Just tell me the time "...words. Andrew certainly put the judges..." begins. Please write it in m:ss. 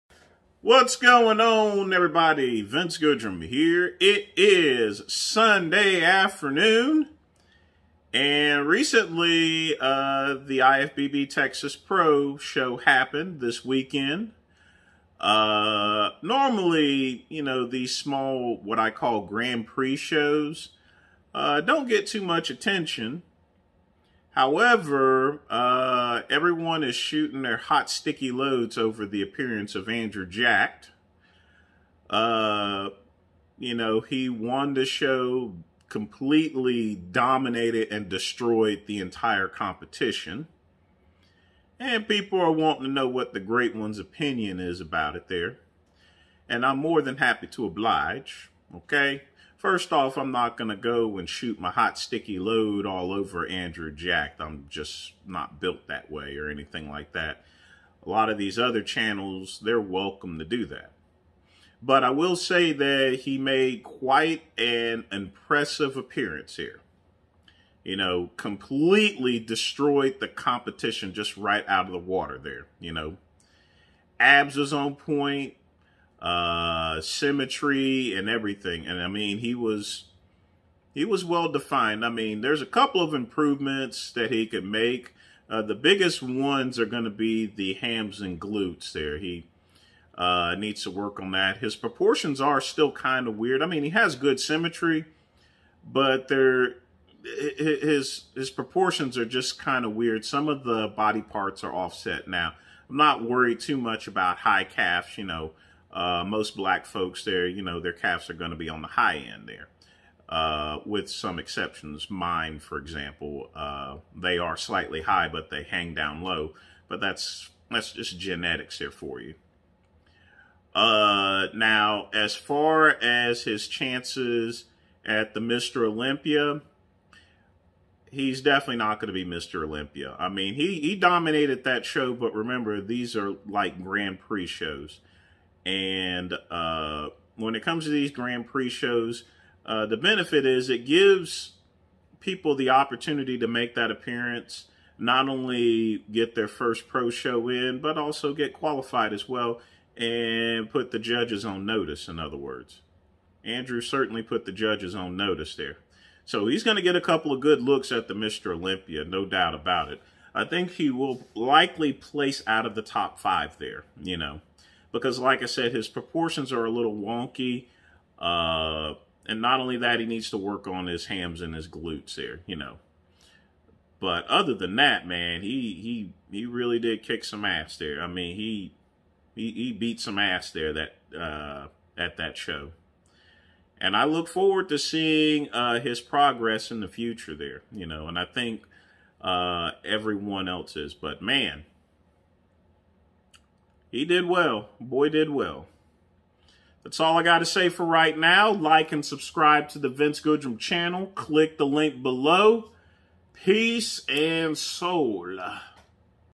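2:32.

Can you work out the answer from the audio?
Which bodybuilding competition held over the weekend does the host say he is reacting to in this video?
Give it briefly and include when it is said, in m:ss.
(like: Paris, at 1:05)
IFBB Texas Pro, at 0:10.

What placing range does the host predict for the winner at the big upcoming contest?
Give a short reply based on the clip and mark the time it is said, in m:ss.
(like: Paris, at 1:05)
out of the top five, at 2:42.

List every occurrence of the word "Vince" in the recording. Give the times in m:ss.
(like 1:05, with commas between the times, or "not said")
0:02, 3:19.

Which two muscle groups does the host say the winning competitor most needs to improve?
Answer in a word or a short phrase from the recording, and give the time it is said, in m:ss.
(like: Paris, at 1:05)
hams and glutes, at 1:27.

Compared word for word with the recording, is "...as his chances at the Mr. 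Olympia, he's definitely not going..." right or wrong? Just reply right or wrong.
right.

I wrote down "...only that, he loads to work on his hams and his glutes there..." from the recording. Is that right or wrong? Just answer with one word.
wrong.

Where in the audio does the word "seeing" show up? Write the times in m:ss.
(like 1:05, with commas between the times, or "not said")
3:04.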